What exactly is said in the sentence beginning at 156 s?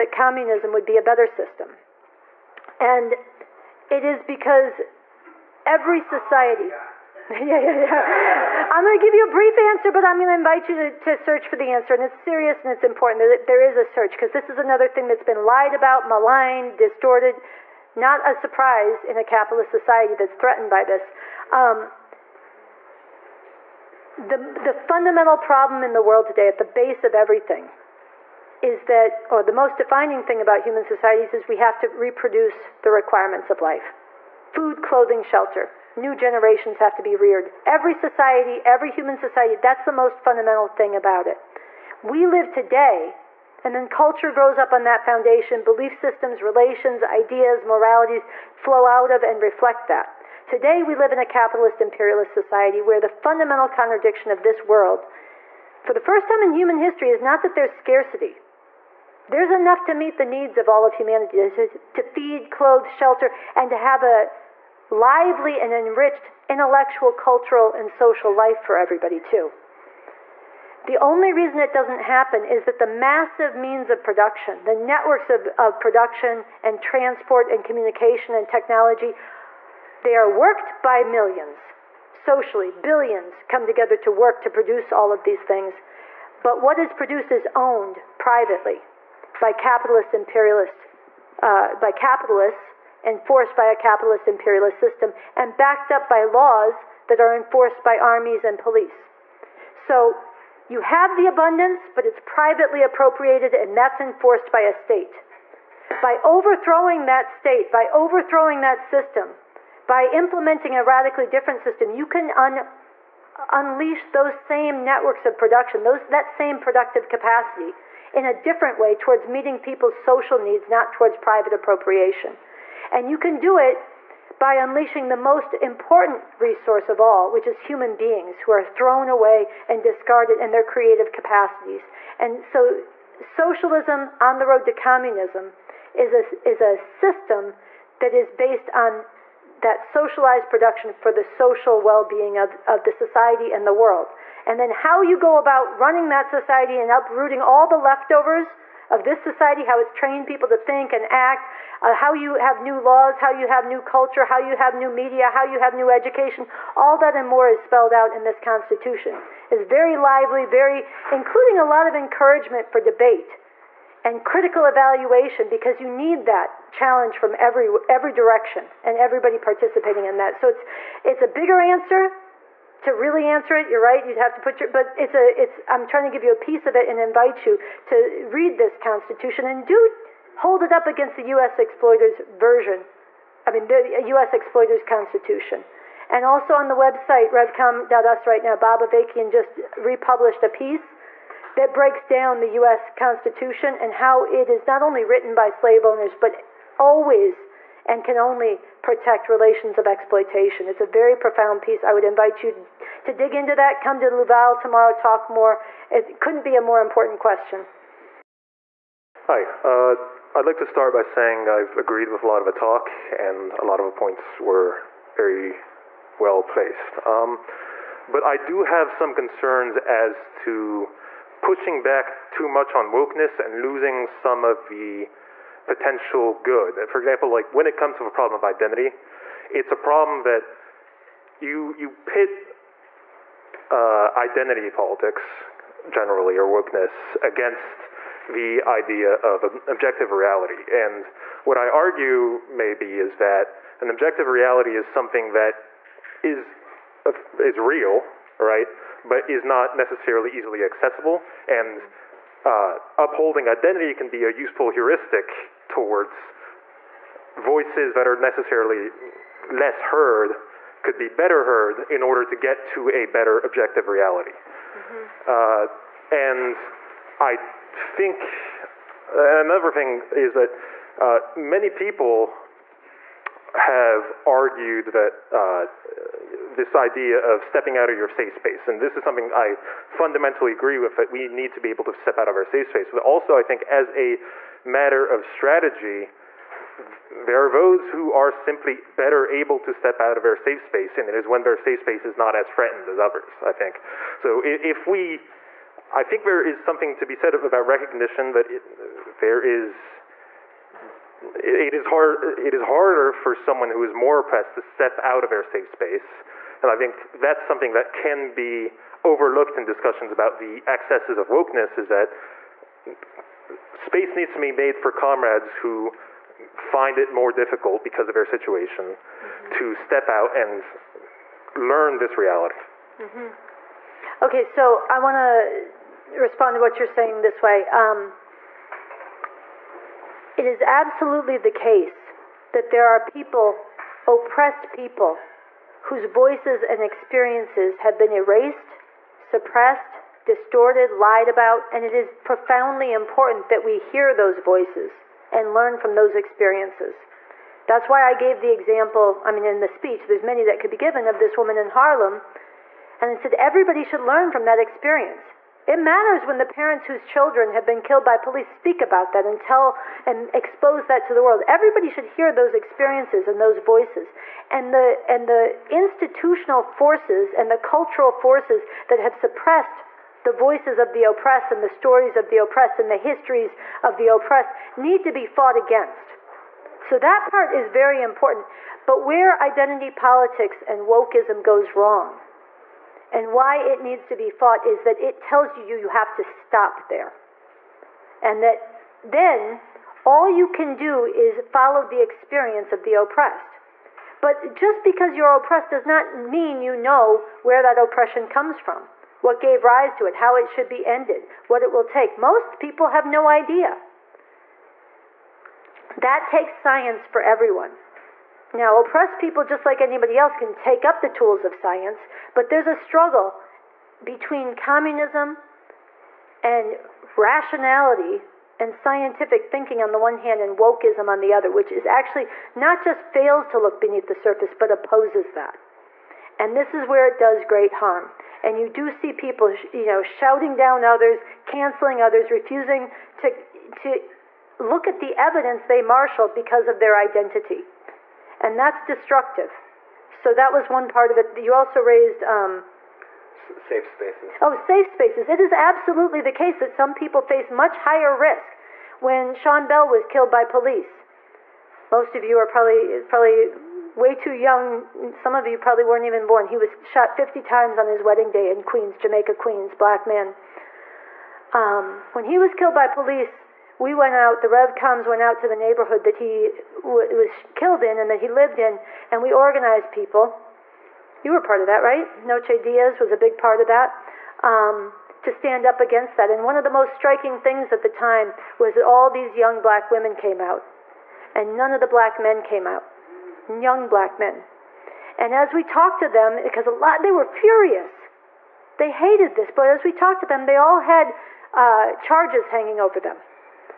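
All that and more is spelled out in this Constitution.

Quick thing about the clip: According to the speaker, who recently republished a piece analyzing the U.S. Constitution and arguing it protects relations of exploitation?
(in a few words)
Bob Avakian.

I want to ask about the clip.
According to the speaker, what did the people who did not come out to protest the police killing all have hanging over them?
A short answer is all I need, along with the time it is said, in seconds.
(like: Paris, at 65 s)
Charges, at 491 s.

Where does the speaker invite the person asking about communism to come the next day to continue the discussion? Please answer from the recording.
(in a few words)
Louvain.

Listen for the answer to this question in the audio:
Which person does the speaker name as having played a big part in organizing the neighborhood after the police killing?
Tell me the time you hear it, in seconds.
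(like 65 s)
472 s.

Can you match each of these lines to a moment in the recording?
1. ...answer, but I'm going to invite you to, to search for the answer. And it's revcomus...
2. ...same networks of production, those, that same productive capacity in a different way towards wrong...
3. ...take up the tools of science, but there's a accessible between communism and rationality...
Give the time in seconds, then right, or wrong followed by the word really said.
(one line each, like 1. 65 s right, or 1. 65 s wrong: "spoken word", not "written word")
1. 9 s wrong: "serious", not "revcomus"
2. 114 s wrong: "meeting", not "wrong"
3. 410 s wrong: "struggle", not "accessible".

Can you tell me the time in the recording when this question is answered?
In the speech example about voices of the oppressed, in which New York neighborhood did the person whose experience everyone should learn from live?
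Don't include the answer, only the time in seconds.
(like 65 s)
351 s.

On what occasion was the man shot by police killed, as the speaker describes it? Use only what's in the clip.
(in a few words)
His wedding day.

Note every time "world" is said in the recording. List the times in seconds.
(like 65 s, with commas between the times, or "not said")
26 s, 54 s, 143 s, 361 s.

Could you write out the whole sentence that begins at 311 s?
Is that space needs to be made for comrades who find it more difficult because of their situation mm-hmm.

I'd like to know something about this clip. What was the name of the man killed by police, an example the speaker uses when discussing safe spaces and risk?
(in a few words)
Sean Bell.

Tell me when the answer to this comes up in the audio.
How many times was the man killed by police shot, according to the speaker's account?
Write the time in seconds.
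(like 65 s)
457 s.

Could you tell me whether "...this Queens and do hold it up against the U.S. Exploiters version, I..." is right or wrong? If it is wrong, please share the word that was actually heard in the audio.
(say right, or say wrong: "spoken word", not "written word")
wrong: "Constitution", not "Queens".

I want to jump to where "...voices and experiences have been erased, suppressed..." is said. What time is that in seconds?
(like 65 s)
336 s.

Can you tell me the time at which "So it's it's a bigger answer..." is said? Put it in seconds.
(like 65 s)
170 s.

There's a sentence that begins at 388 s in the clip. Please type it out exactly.
And that then all you can do is follow the experience of the oppressed.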